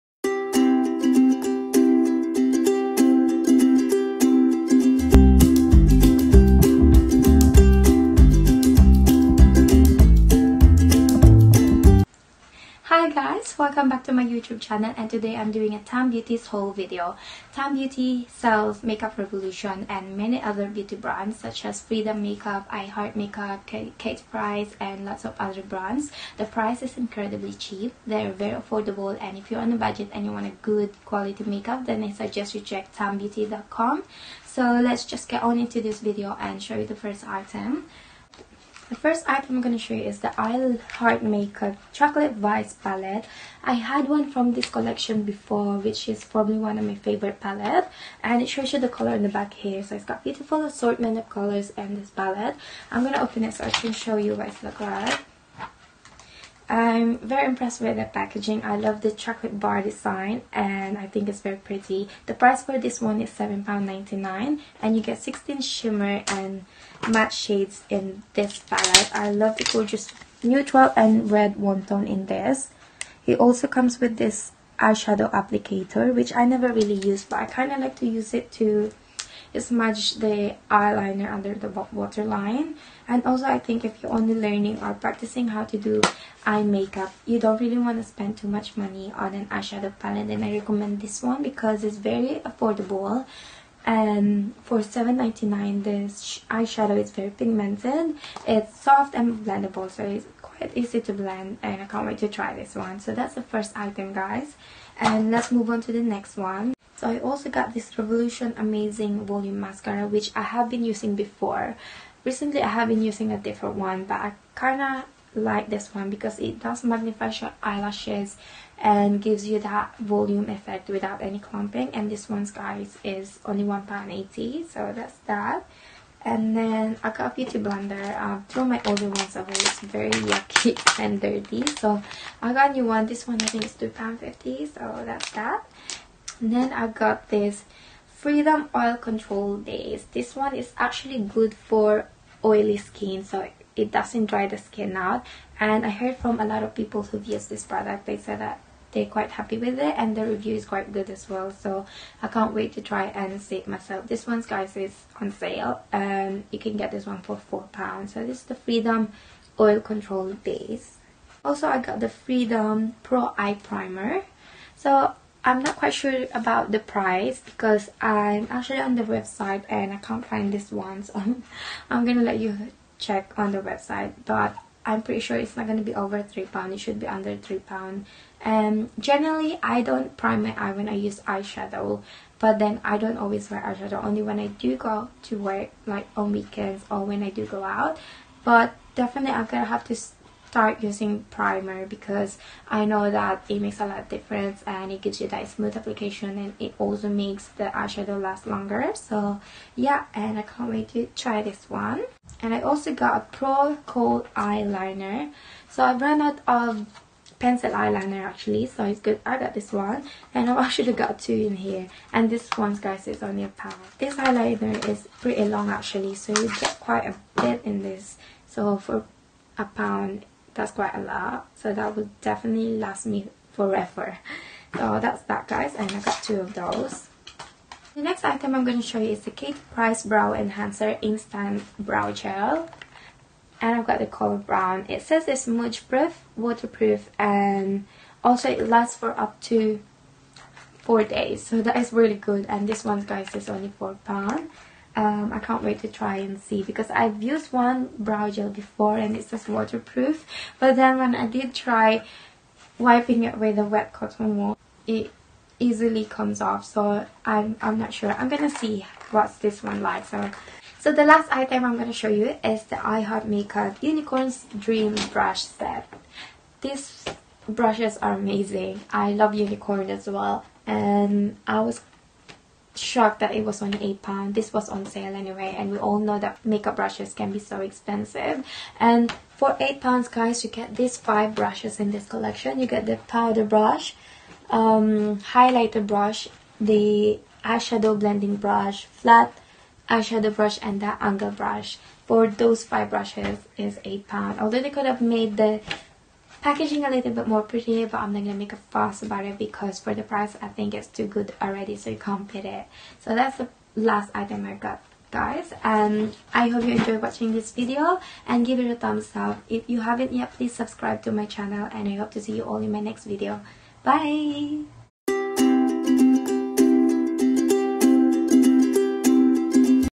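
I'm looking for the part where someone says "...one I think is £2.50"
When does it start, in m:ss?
2:13.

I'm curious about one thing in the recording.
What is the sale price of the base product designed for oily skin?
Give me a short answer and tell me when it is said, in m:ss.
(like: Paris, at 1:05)
£4, at 2:37.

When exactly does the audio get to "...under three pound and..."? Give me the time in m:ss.
2:57.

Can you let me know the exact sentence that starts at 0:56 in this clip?
I'm very impressed with the packaging.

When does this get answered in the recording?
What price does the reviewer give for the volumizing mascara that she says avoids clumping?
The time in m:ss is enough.
2:03.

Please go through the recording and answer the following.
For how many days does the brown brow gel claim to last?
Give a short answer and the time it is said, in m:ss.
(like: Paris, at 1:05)
4, at 4:00.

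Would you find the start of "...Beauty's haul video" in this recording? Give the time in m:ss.
0:16.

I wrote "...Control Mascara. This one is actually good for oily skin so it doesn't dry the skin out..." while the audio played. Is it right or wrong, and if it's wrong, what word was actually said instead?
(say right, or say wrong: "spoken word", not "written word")
wrong: "Base", not "Mascara".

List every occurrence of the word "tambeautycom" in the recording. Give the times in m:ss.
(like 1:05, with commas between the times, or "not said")
0:32.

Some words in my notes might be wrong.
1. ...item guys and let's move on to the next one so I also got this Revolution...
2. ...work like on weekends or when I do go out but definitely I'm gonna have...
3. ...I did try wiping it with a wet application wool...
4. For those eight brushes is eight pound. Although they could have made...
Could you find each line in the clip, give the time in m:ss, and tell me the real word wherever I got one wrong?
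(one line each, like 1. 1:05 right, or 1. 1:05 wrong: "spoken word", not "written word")
1. 1:43 right
2. 3:05 right
3. 4:11 wrong: "cotton", not "application"
4. 4:52 wrong: "five", not "eight".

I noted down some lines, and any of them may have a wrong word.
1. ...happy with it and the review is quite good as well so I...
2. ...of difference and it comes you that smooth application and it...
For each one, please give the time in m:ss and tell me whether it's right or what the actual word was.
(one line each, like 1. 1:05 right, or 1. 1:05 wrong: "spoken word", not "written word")
1. 2:29 right
2. 3:13 wrong: "gives", not "comes".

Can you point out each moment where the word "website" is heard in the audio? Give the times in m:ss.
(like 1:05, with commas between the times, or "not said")
2:49, 2:53.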